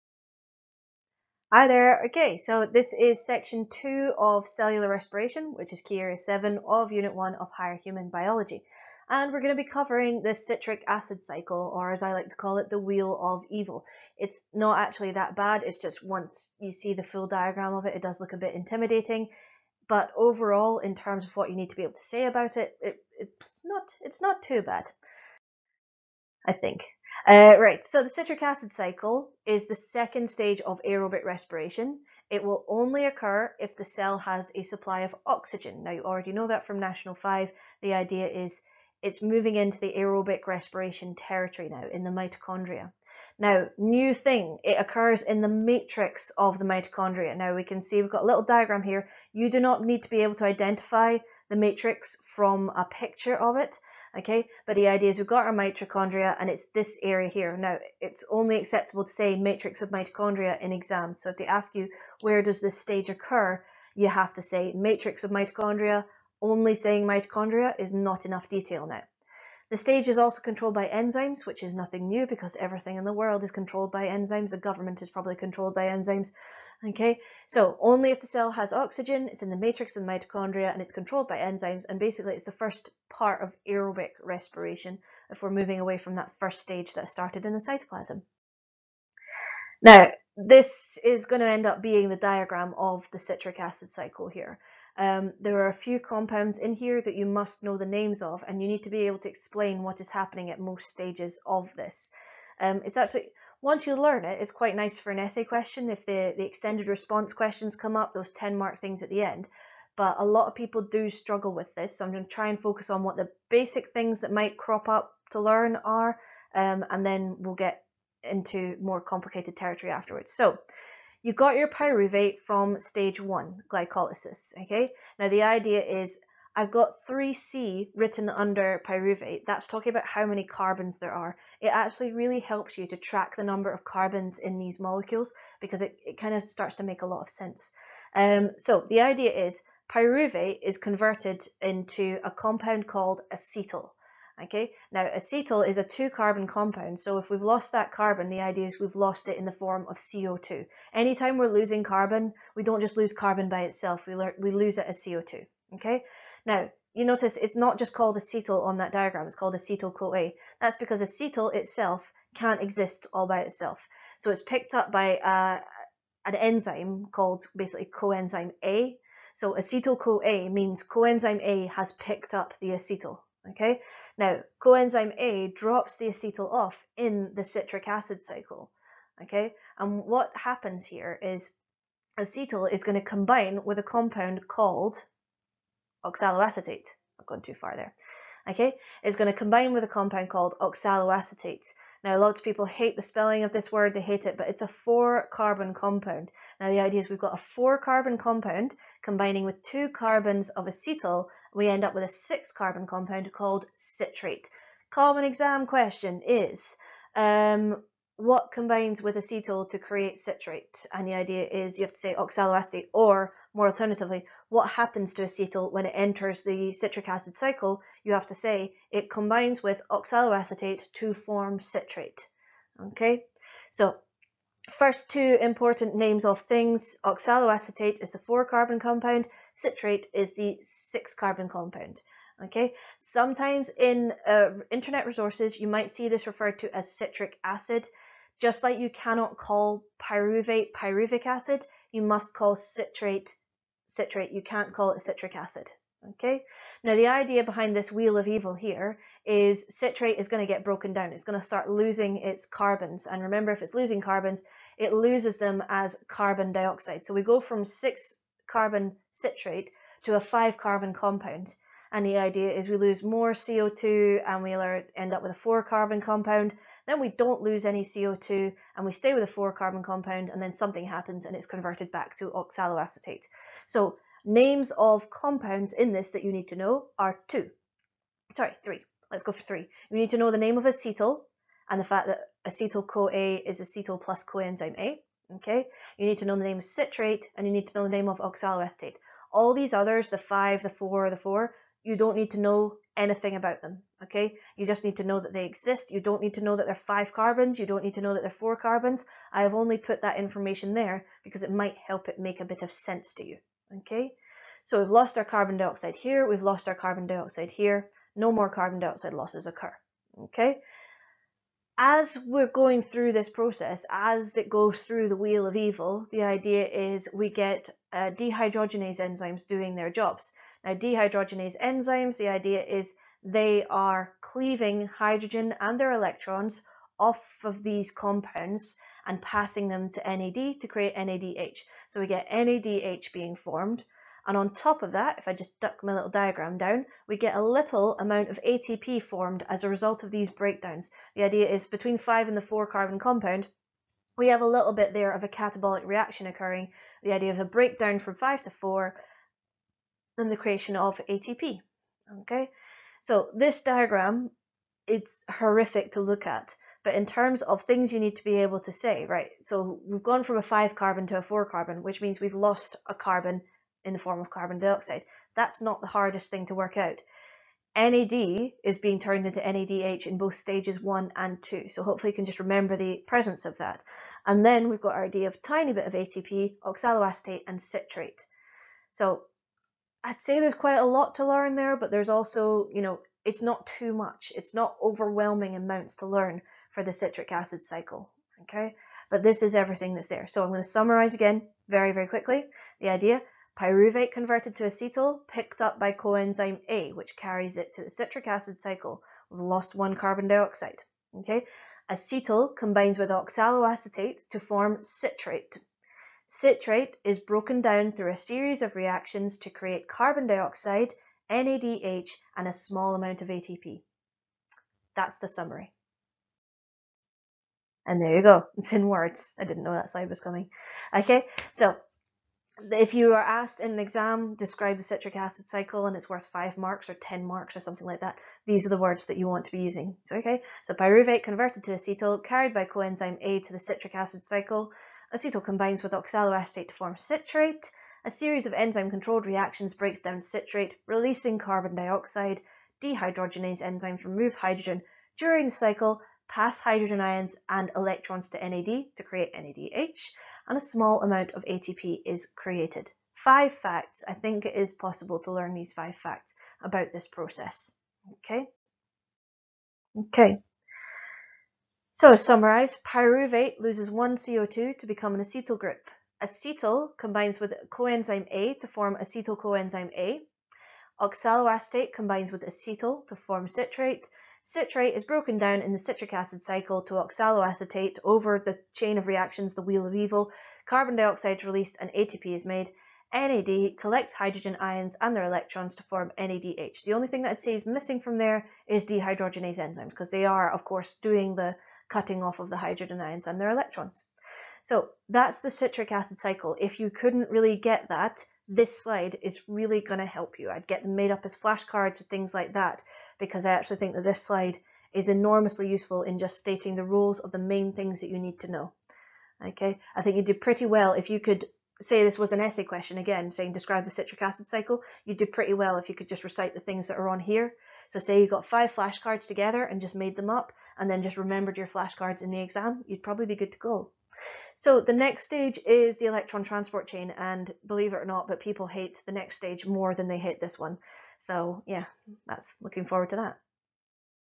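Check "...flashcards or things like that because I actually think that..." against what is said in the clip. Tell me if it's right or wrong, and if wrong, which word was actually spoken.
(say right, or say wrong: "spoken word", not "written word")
right.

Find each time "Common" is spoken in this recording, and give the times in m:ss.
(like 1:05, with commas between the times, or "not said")
3:24.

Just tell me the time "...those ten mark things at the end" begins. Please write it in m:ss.
1:48.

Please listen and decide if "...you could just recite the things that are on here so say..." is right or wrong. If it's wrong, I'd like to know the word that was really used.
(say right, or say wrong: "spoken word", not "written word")
right.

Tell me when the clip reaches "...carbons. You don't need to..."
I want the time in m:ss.
4:57.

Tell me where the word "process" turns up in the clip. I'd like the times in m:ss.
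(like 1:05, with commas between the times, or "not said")
5:13, 7:37.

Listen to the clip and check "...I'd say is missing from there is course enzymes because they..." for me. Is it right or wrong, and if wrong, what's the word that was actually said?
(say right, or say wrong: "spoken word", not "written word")
wrong: "dehydrogenase", not "course".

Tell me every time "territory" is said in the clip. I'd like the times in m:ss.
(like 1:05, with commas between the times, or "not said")
0:41, 1:59.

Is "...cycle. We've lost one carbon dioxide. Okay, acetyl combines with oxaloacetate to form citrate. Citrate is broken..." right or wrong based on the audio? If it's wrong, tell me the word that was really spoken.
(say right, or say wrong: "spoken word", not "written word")
right.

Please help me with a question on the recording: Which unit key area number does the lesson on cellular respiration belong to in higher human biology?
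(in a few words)
7.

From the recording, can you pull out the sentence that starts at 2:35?
Okay, now, you notice it's not just called acetyl on that diagram, it's called acetyl-CoA.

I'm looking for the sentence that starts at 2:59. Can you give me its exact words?
Okay, and what happens here is acetyl is going to combine with a compound called oxaloacetate.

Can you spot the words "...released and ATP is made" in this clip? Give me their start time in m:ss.
8:01.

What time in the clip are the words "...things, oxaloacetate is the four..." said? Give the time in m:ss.
3:46.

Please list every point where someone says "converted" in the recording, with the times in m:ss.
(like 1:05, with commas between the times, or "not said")
2:20, 4:31, 6:34, 7:11.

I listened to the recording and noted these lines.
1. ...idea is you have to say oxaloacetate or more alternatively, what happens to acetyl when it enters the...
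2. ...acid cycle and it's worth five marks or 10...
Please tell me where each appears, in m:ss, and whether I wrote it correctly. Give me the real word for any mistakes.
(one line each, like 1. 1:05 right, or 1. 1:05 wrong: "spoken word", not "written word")
1. 3:31 right
2. 7:05 right.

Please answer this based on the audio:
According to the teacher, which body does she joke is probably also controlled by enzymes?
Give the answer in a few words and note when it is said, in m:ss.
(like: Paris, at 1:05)
The government, at 1:14.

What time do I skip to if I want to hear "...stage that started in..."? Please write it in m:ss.
1:26.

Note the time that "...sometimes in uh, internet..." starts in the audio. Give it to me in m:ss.
3:52.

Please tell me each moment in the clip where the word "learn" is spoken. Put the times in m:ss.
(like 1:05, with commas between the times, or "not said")
1:43, 1:55, 6:21, 6:26, 7:35.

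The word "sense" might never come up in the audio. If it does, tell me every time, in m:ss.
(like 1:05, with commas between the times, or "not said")
2:17, 5:02.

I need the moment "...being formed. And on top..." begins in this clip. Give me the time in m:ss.
5:33.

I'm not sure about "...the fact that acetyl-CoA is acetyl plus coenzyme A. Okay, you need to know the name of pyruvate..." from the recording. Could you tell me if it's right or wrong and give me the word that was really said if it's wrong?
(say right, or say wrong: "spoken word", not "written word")
wrong: "citrate", not "pyruvate".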